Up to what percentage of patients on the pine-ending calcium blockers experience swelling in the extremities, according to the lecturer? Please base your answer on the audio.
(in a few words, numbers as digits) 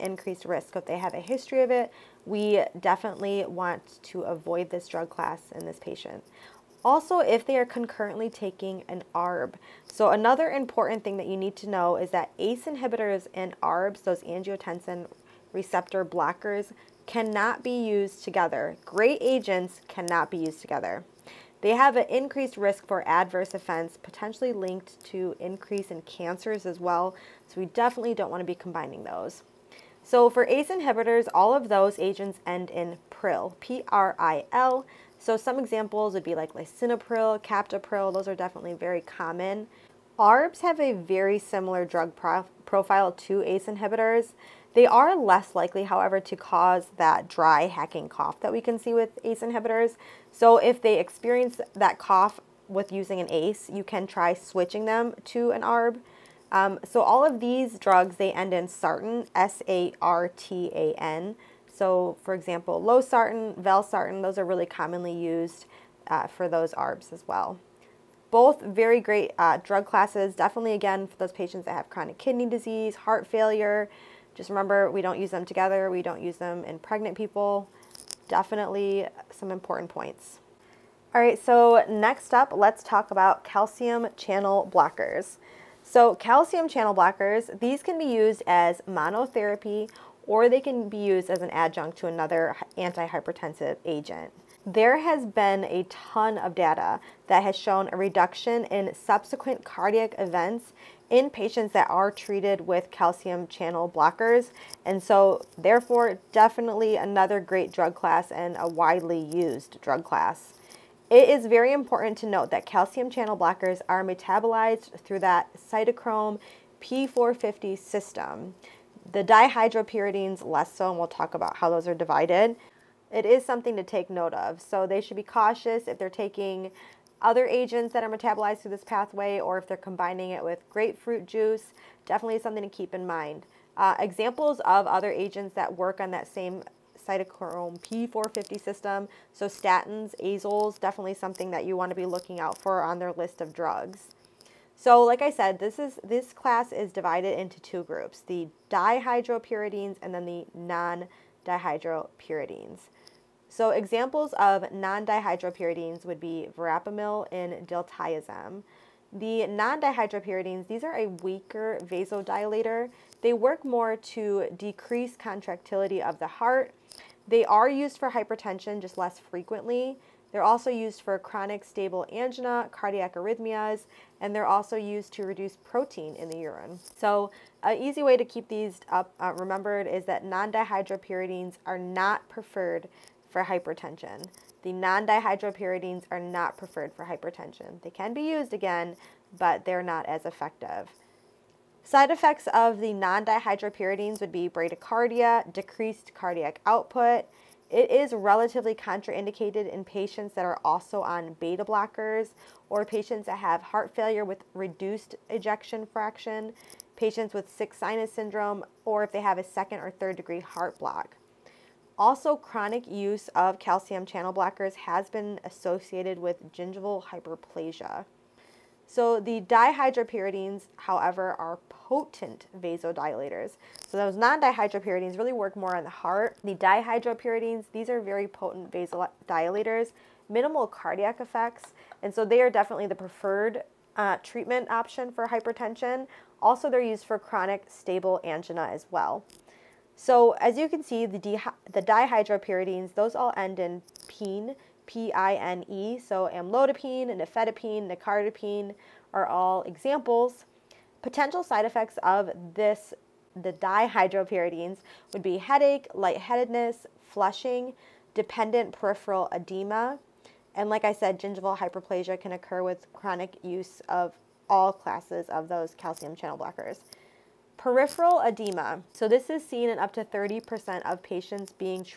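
30%.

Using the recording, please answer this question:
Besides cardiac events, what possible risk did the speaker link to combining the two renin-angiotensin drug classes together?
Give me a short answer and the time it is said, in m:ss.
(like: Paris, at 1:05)
Increase in cancers, at 0:25.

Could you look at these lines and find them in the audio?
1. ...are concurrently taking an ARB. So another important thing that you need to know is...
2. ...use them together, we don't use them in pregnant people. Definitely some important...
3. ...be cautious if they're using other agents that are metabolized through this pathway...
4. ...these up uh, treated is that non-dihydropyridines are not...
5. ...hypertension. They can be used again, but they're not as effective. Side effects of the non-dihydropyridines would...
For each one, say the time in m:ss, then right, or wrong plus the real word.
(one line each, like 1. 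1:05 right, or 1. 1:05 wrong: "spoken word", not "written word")
1. 0:07 right
2. 1:15 right
3. 2:05 wrong: "taking", not "using"
4. 2:58 wrong: "remembered", not "treated"
5. 3:07 right.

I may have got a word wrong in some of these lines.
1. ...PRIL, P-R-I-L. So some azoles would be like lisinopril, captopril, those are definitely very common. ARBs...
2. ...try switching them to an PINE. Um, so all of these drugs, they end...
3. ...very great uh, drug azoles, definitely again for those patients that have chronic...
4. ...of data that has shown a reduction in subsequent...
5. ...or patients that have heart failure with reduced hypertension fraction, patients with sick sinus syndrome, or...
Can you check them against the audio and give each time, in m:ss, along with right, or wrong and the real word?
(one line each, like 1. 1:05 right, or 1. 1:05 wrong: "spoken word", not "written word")
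1. 0:33 wrong: "examples", not "azoles"
2. 0:54 wrong: "ARB", not "PINE"
3. 1:08 wrong: "classes", not "azoles"
4. 1:36 right
5. 3:22 wrong: "ejection", not "hypertension".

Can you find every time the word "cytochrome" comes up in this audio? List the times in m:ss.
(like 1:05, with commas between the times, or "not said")
1:55, 2:17.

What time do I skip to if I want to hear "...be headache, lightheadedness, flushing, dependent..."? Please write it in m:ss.
4:15.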